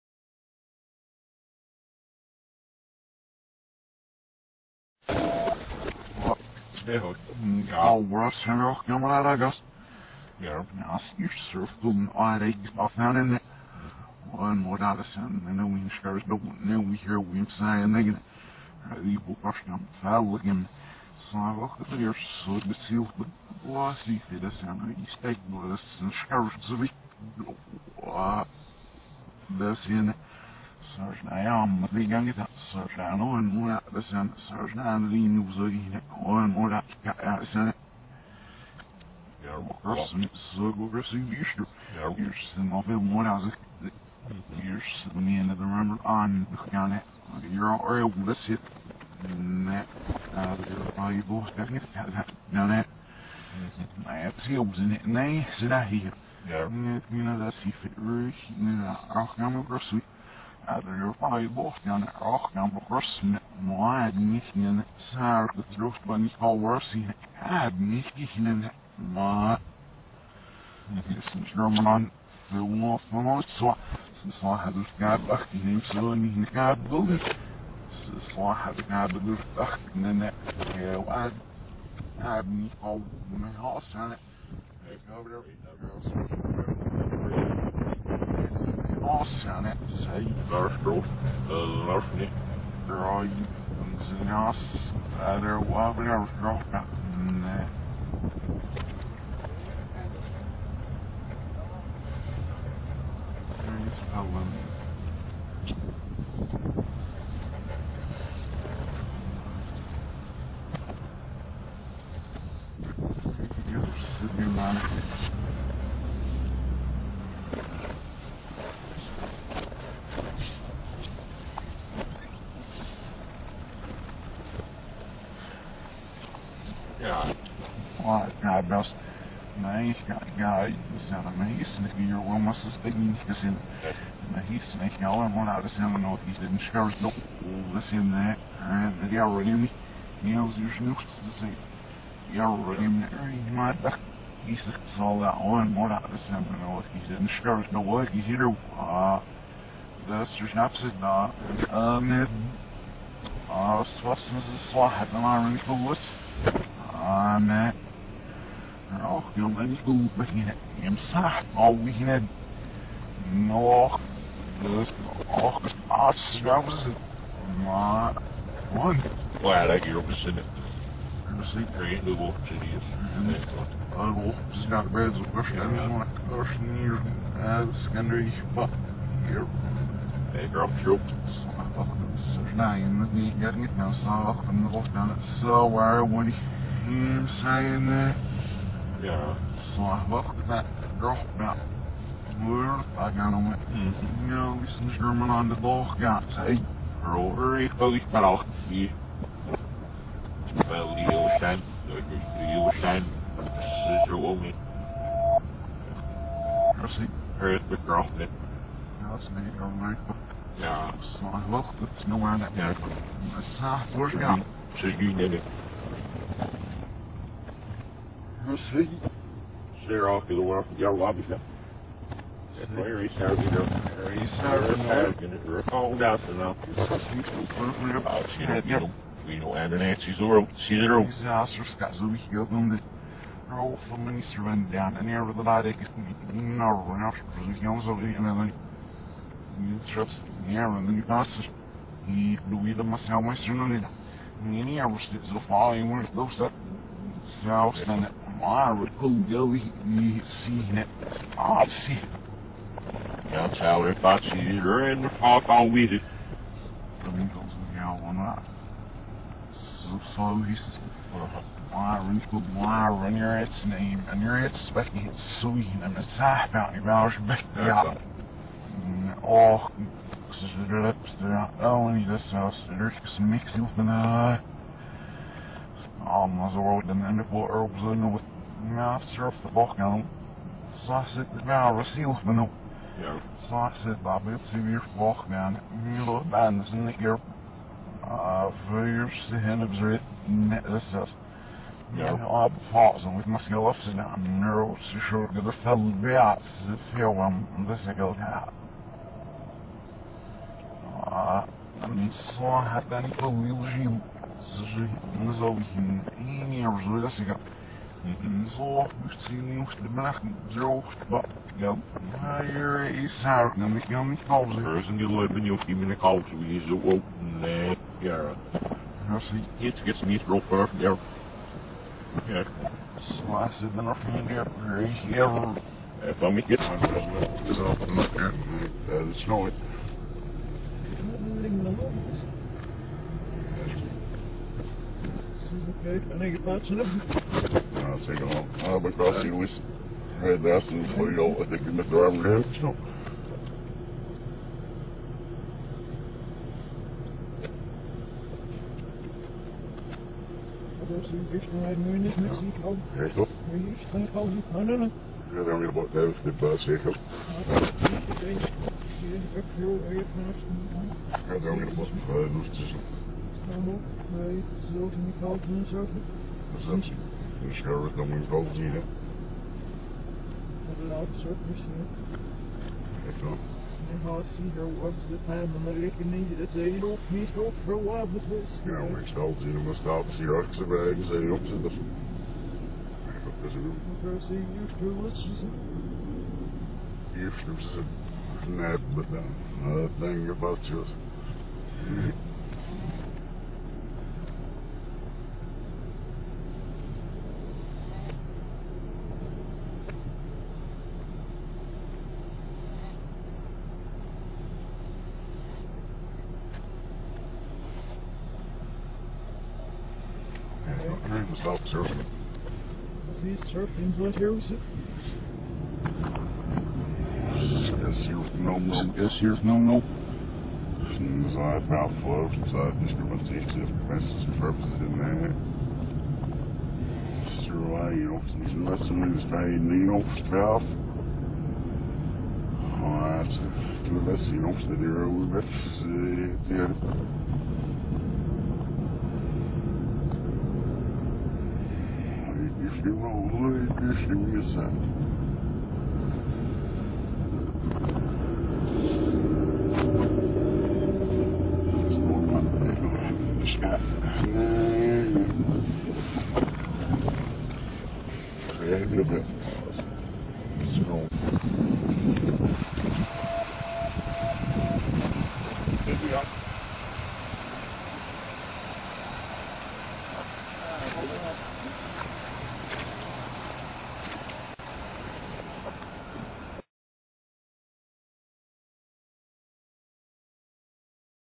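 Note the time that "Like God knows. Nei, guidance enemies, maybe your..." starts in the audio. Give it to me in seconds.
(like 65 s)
128 s.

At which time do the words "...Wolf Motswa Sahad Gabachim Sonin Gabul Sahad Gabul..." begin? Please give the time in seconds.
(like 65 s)
72 s.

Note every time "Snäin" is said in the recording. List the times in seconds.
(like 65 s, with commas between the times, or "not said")
182 s.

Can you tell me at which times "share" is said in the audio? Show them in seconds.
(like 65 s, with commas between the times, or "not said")
136 s, 147 s.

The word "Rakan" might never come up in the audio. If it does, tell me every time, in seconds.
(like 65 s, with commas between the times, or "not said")
62 s.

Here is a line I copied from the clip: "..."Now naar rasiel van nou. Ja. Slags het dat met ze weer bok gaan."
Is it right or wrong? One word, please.
right.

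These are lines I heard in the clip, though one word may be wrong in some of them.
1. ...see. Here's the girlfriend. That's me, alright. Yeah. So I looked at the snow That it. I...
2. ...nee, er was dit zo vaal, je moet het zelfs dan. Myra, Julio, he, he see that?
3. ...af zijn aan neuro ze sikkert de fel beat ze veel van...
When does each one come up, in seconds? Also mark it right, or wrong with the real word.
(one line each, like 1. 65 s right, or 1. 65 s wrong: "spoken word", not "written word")
1. 206 s right
2. 244 s right
3. 293 s wrong: "short", not "sikkert".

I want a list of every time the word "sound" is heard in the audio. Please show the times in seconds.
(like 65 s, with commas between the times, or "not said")
135 s, 146 s.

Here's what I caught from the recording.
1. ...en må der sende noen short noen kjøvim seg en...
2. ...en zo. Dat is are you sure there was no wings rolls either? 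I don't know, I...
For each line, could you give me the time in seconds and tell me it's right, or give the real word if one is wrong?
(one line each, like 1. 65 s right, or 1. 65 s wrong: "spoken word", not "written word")
1. 14 s wrong: "skjørt", not "short"
2. 365 s right.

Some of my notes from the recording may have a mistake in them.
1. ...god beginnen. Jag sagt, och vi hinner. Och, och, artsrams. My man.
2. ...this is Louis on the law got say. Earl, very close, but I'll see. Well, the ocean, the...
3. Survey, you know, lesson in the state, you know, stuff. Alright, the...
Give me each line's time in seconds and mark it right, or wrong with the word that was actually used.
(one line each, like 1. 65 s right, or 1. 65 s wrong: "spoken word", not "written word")
1. 159 s right
2. 194 s wrong: "German", not "Louis"
3. 427 s right.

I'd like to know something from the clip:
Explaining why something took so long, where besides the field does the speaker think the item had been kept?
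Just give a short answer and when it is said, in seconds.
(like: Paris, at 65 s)
driving range, at 341 s.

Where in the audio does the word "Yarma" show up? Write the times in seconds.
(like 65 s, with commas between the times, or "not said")
39 s, 56 s.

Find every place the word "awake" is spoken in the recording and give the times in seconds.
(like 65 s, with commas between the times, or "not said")
not said.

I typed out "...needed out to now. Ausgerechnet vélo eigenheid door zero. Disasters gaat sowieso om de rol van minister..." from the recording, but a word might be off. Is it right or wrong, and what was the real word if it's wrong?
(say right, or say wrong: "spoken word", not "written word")
wrong: "called", not "needed".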